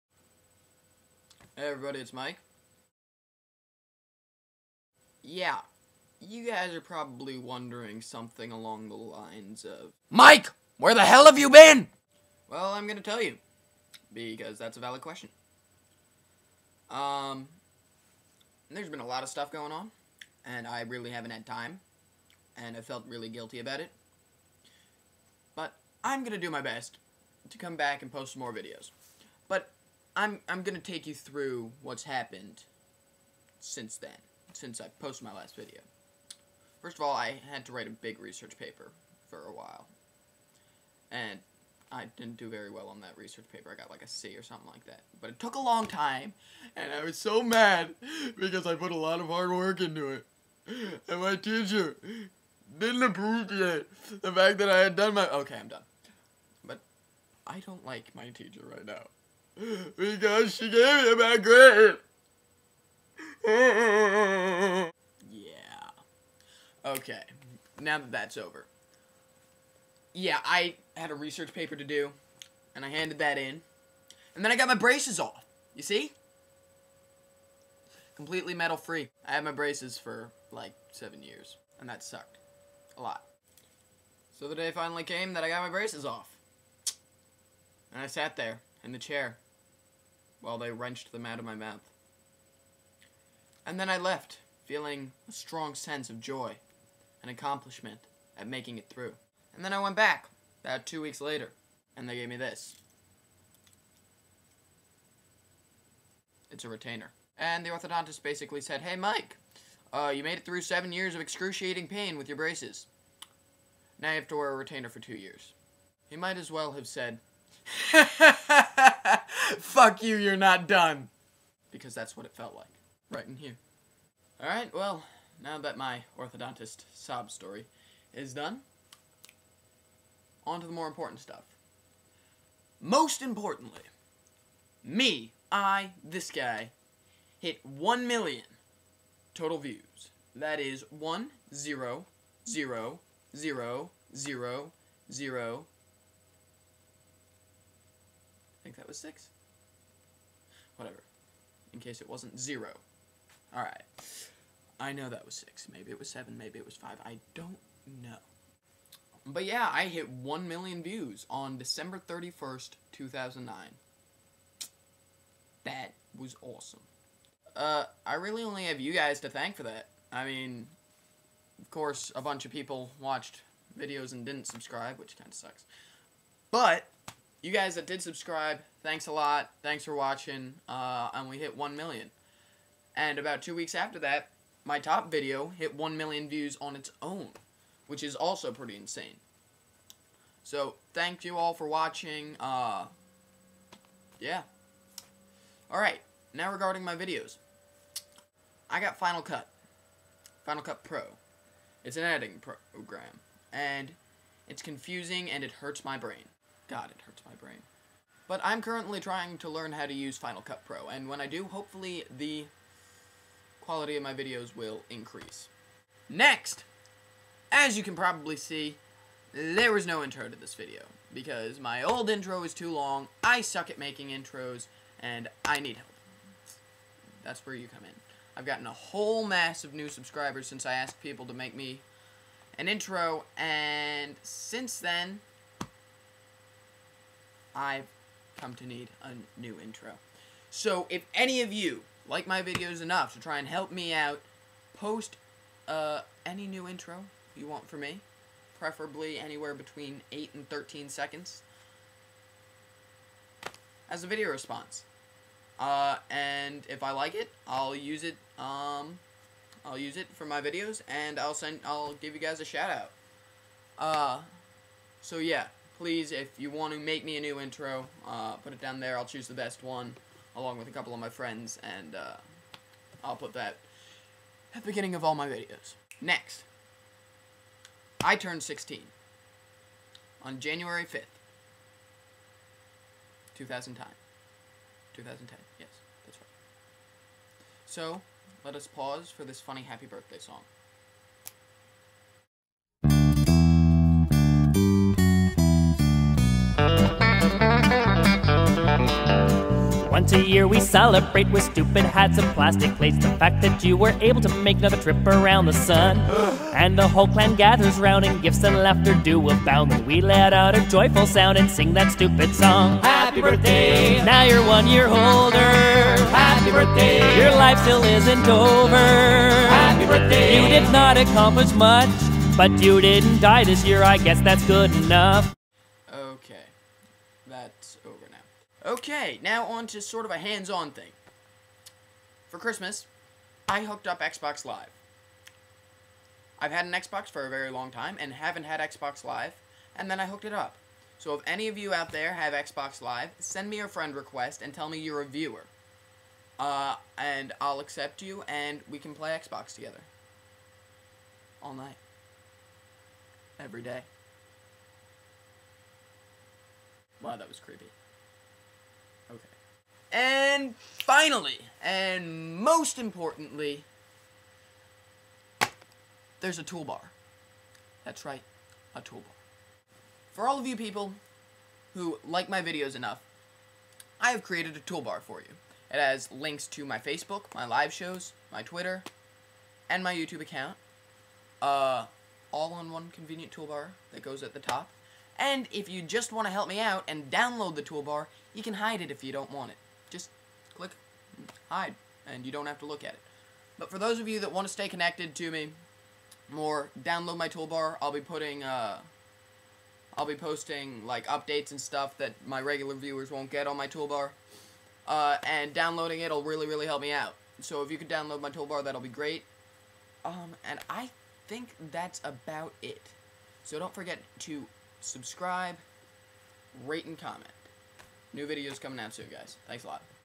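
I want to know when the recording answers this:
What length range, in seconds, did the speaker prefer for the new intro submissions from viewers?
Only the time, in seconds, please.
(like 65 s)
249 s.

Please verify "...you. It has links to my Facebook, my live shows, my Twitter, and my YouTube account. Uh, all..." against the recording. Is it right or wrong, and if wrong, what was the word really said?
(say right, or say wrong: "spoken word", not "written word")
right.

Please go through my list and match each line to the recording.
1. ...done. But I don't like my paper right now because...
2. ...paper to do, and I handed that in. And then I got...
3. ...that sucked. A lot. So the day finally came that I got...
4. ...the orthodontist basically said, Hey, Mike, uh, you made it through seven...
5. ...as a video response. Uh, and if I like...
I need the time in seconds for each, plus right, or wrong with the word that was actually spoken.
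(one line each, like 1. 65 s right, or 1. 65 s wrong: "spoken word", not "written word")
1. 55 s wrong: "teacher", not "paper"
2. 71 s right
3. 81 s right
4. 107 s right
5. 253 s right.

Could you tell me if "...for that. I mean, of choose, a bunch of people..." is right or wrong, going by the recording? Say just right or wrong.
wrong.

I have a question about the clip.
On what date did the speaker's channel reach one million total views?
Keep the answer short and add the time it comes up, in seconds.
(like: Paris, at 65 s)
December 31st, 2009, at 161 s.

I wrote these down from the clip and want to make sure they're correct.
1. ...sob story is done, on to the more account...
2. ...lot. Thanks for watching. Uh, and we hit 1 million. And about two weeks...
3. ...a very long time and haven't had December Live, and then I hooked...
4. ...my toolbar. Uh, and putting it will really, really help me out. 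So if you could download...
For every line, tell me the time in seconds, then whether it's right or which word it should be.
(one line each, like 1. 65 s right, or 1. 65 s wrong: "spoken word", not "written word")
1. 126 s wrong: "important", not "account"
2. 179 s right
3. 337 s wrong: "Xbox", not "December"
4. 403 s wrong: "downloading", not "putting".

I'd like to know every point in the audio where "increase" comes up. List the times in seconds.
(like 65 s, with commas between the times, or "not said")
214 s.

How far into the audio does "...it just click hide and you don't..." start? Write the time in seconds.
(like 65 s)
389 s.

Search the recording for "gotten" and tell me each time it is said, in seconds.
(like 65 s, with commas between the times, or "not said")
228 s.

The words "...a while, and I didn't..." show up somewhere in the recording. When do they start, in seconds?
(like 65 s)
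39 s.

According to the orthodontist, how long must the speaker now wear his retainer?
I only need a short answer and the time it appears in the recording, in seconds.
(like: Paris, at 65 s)
2 years, at 114 s.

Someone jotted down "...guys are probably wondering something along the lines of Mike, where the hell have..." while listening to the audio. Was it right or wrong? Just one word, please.
right.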